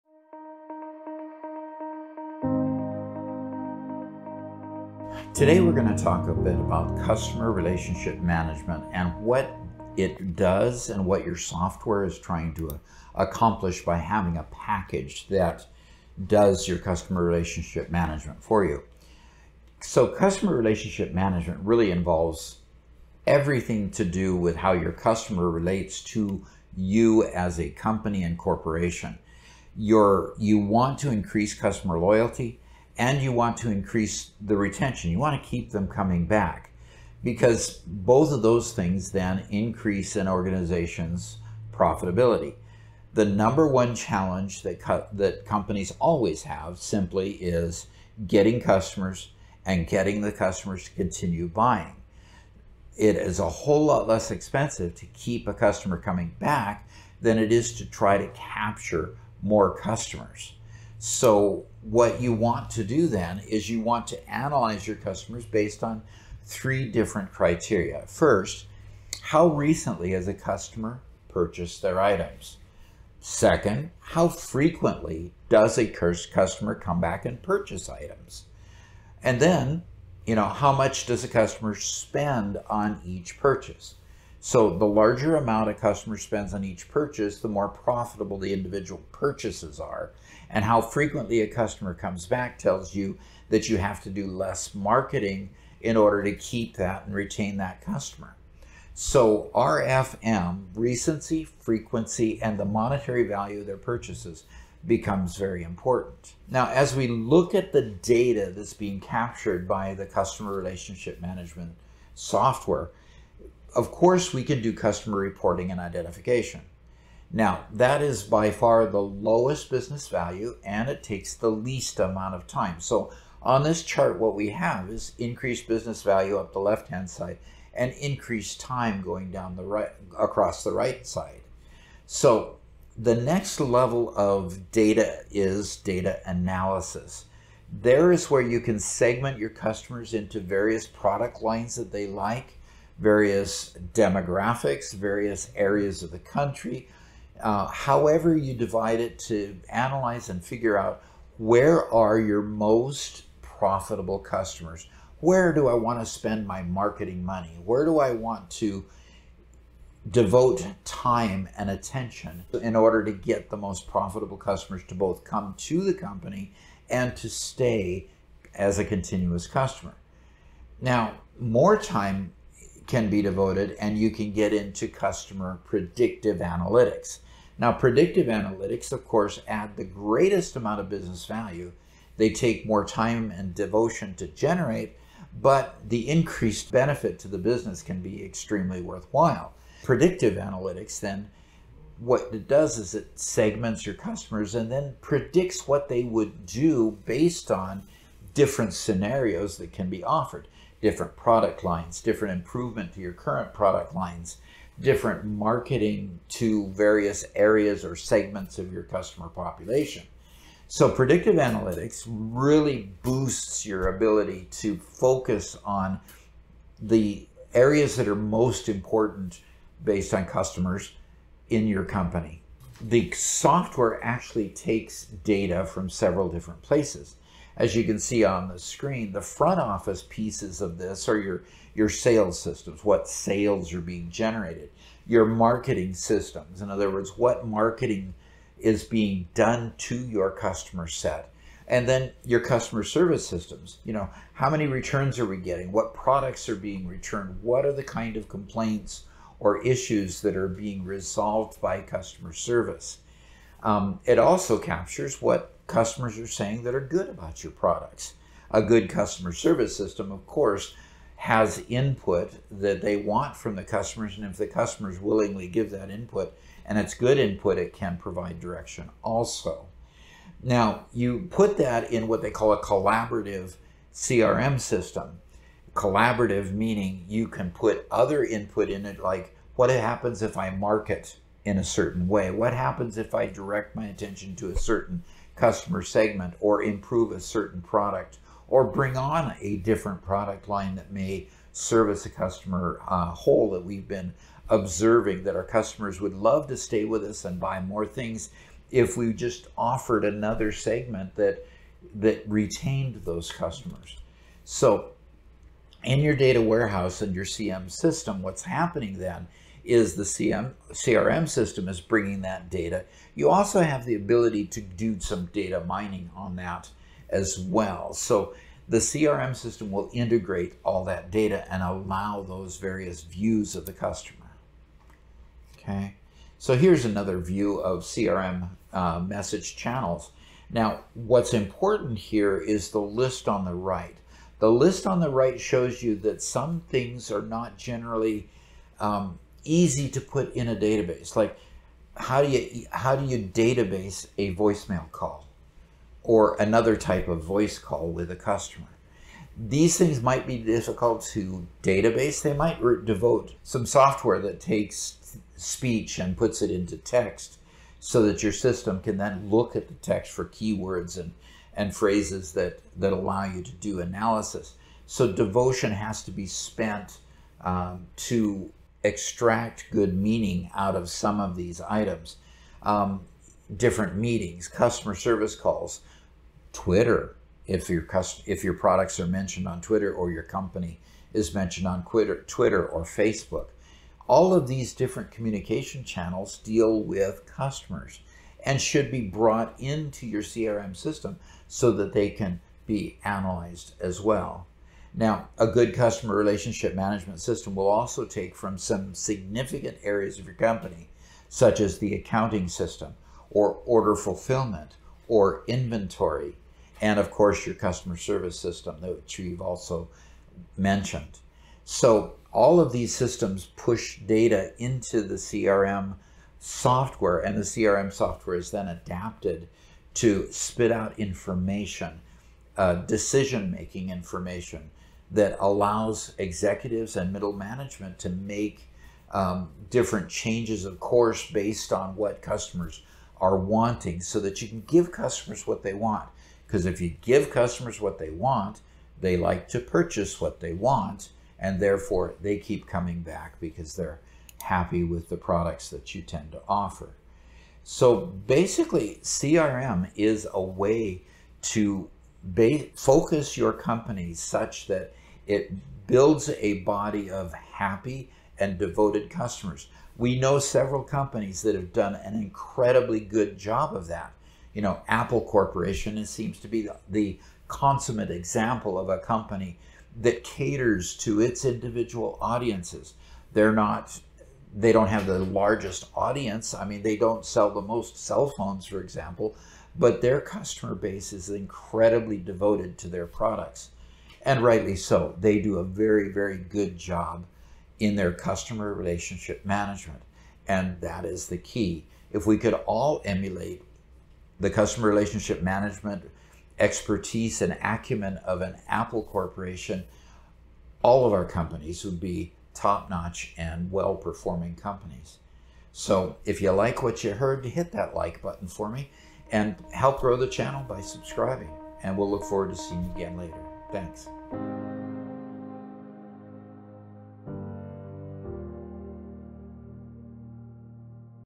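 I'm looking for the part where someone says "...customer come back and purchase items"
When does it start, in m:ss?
1:15.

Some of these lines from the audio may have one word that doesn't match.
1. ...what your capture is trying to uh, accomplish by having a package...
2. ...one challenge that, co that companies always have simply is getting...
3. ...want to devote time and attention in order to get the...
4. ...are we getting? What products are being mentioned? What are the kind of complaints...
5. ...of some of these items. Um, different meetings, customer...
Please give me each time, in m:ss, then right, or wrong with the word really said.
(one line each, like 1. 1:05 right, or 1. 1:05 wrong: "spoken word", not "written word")
1. 0:11 wrong: "software", not "capture"
2. 0:43 right
3. 2:38 right
4. 4:05 wrong: "returned", not "mentioned"
5. 6:10 right.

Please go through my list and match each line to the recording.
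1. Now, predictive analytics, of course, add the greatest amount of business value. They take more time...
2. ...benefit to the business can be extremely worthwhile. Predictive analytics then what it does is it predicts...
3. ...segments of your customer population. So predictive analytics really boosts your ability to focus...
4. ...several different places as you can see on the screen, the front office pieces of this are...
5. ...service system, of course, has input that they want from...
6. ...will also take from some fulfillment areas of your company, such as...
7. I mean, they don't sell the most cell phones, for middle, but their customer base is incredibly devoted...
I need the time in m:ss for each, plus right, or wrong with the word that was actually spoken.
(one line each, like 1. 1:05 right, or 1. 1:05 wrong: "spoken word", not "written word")
1. 2:57 right
2. 3:06 wrong: "segments", not "predicts"
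3. 3:27 right
4. 3:45 right
5. 4:19 right
6. 6:37 wrong: "significant", not "fulfillment"
7. 7:56 wrong: "example", not "middle".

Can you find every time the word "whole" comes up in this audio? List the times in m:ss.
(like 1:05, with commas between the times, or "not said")
0:53, 4:53.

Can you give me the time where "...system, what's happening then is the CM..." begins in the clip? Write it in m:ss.
5:07.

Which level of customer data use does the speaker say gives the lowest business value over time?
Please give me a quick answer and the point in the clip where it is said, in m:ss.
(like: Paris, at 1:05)
customer reporting and identification, at 1:54.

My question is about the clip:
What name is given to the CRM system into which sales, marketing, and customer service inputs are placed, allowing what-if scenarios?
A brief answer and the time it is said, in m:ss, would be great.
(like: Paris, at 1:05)
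collaborative CRM system, at 4:32.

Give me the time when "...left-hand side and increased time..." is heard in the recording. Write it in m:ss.
2:06.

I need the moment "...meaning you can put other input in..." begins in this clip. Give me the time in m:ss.
4:36.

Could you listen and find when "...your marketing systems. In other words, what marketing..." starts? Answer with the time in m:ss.
3:55.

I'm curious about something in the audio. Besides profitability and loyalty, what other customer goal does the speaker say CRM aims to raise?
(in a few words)
retention.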